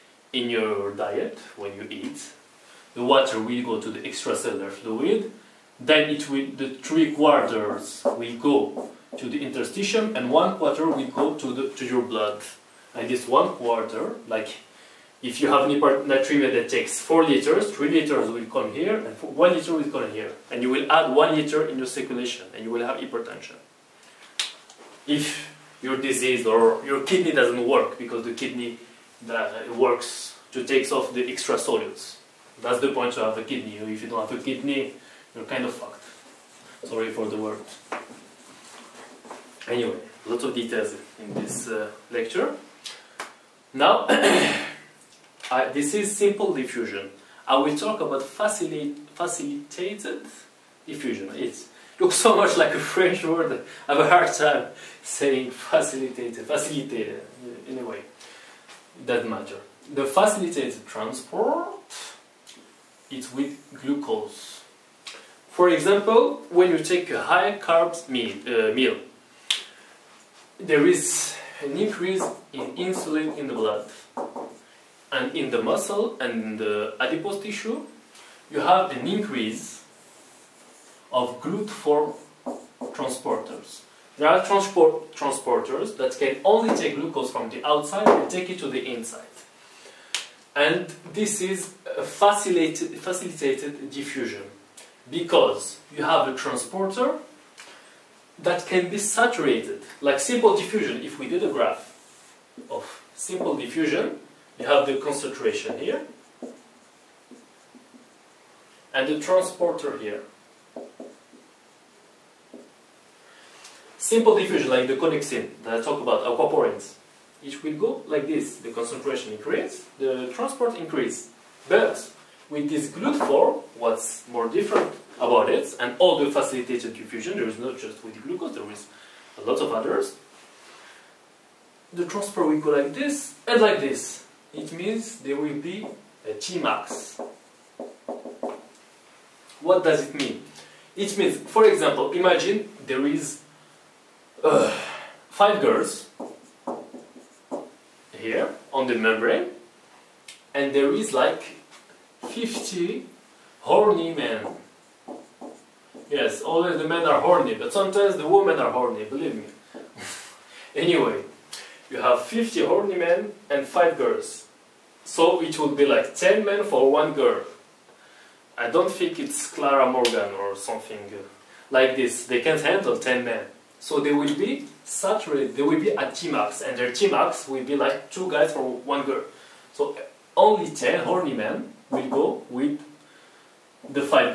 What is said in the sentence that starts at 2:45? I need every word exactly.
So it would be like 10 men for one girl.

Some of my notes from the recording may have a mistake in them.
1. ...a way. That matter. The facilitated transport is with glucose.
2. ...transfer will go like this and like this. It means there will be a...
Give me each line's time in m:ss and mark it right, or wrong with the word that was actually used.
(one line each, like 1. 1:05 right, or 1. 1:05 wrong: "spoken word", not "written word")
1. 0:57 right
2. 2:12 right.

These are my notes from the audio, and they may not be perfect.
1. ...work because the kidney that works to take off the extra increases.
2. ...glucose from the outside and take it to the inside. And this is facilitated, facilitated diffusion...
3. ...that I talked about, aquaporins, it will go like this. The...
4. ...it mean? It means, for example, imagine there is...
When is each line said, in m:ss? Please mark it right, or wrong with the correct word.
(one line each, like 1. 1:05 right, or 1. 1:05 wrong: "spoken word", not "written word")
1. 0:27 wrong: "solutes", not "increases"
2. 1:26 right
3. 1:55 right
4. 2:20 right.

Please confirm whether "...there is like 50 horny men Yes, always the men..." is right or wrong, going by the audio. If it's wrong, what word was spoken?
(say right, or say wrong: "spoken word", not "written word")
right.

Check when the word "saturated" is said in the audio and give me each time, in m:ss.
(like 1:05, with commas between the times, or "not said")
1:38, 2:54.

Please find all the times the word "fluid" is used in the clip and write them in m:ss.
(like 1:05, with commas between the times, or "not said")
0:04.